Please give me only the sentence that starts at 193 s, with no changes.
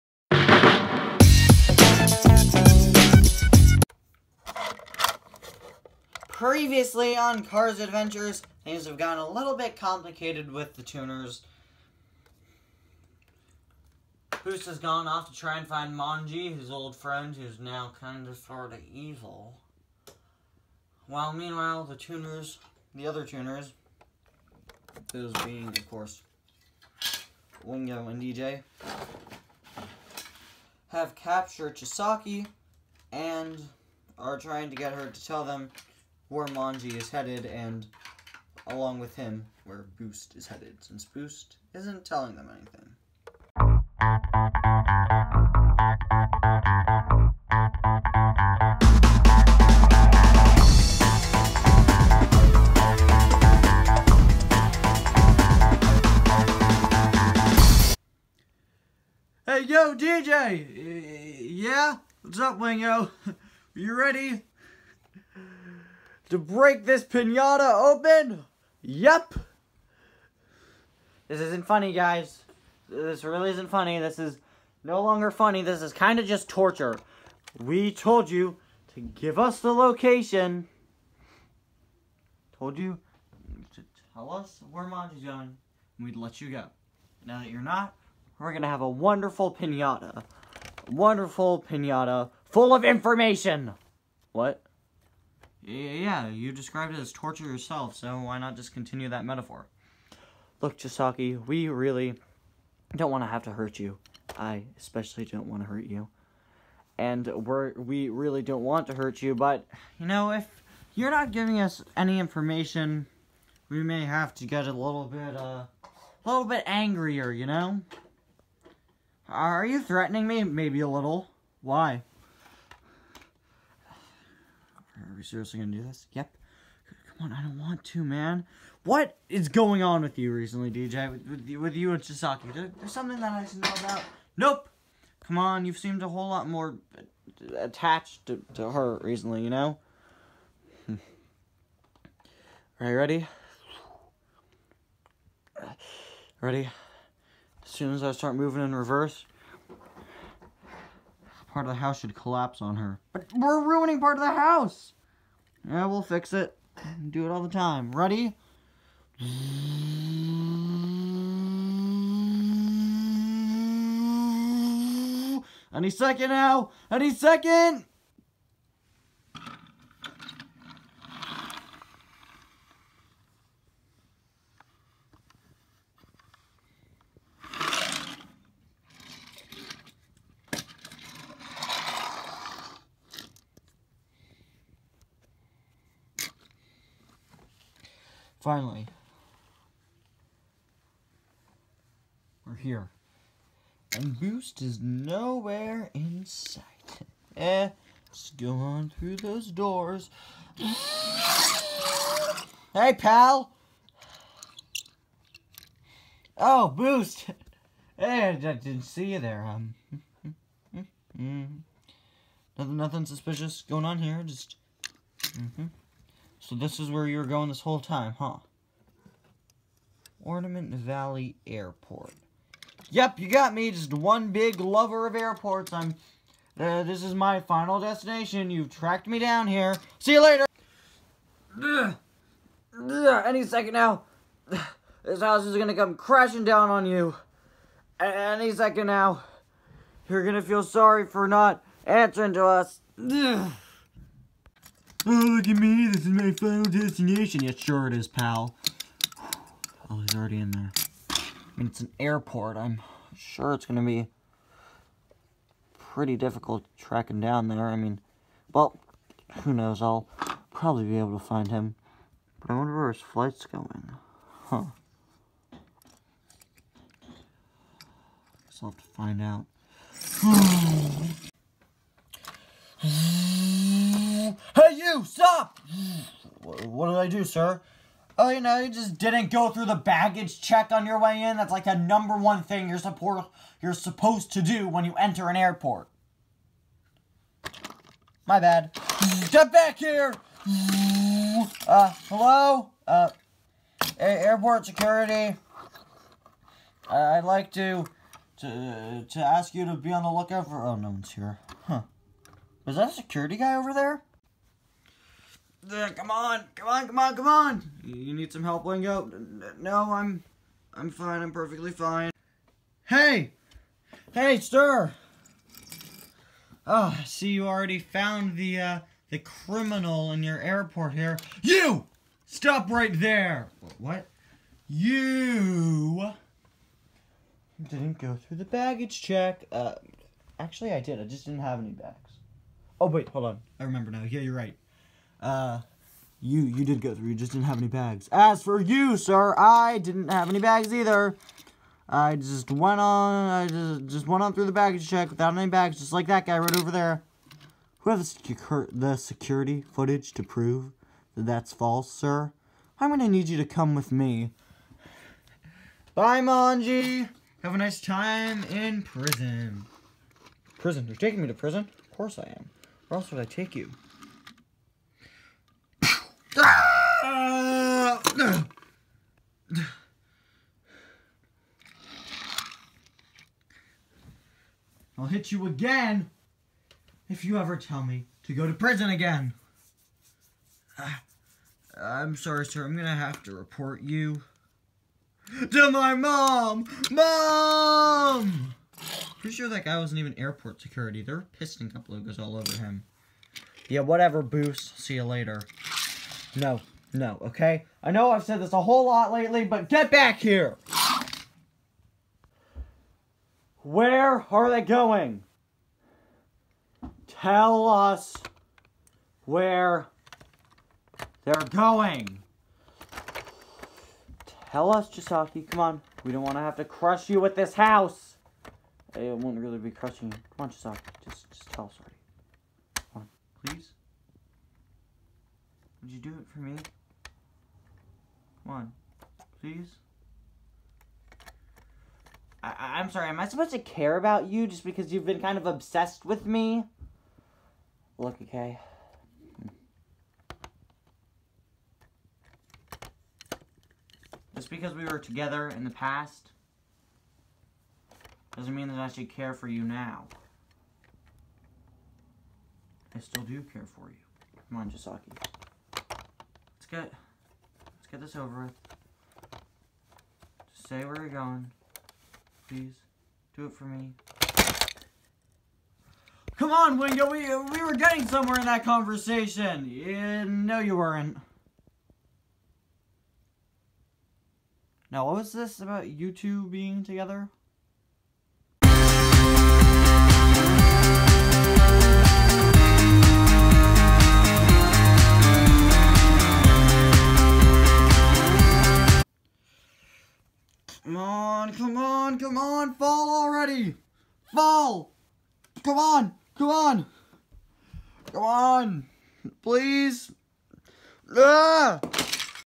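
And Boost is nowhere in sight.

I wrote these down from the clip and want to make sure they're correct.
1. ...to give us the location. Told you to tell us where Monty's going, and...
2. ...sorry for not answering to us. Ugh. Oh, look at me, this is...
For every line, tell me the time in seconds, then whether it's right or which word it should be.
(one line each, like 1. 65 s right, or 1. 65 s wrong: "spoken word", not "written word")
1. 78 s right
2. 240 s right.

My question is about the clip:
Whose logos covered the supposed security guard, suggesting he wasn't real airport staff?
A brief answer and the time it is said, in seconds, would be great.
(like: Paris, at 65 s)
Piston Cup, at 391 s.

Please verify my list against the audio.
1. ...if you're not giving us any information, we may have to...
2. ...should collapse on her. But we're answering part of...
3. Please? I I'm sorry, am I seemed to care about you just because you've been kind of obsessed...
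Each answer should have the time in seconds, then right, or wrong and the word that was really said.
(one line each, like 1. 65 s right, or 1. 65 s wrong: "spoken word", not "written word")
1. 110 s right
2. 151 s wrong: "ruining", not "answering"
3. 429 s wrong: "supposed", not "seemed".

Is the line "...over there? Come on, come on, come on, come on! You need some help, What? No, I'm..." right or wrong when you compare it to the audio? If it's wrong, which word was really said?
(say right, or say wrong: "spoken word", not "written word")
wrong: "Wingo", not "What".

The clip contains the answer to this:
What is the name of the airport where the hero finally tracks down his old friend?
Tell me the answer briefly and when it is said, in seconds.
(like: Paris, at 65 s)
Ornament Valley Airport, at 220 s.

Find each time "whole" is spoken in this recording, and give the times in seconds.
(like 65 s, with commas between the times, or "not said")
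136 s, 217 s, 398 s.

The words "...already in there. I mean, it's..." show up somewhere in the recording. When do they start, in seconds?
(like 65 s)
250 s.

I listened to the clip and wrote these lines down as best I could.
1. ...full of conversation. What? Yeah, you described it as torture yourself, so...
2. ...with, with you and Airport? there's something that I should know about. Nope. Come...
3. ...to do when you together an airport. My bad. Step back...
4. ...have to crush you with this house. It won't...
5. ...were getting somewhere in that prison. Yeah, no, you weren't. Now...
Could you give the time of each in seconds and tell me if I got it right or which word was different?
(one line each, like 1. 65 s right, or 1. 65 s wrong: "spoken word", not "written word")
1. 92 s wrong: "information", not "conversation"
2. 131 s wrong: "Chisaki", not "Airport"
3. 284 s wrong: "enter", not "together"
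4. 416 s right
5. 467 s wrong: "conversation", not "prison".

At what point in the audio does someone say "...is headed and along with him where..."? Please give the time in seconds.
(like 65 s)
36 s.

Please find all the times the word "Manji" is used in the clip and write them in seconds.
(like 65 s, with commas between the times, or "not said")
15 s, 36 s, 356 s.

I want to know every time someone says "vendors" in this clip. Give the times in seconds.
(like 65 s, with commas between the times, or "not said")
not said.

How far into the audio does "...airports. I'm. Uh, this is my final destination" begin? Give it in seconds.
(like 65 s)
225 s.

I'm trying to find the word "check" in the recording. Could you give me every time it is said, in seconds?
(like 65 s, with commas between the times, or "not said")
280 s, 329 s, 344 s.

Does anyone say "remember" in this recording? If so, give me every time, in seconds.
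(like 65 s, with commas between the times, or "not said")
333 s.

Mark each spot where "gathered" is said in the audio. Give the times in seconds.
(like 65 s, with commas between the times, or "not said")
not said.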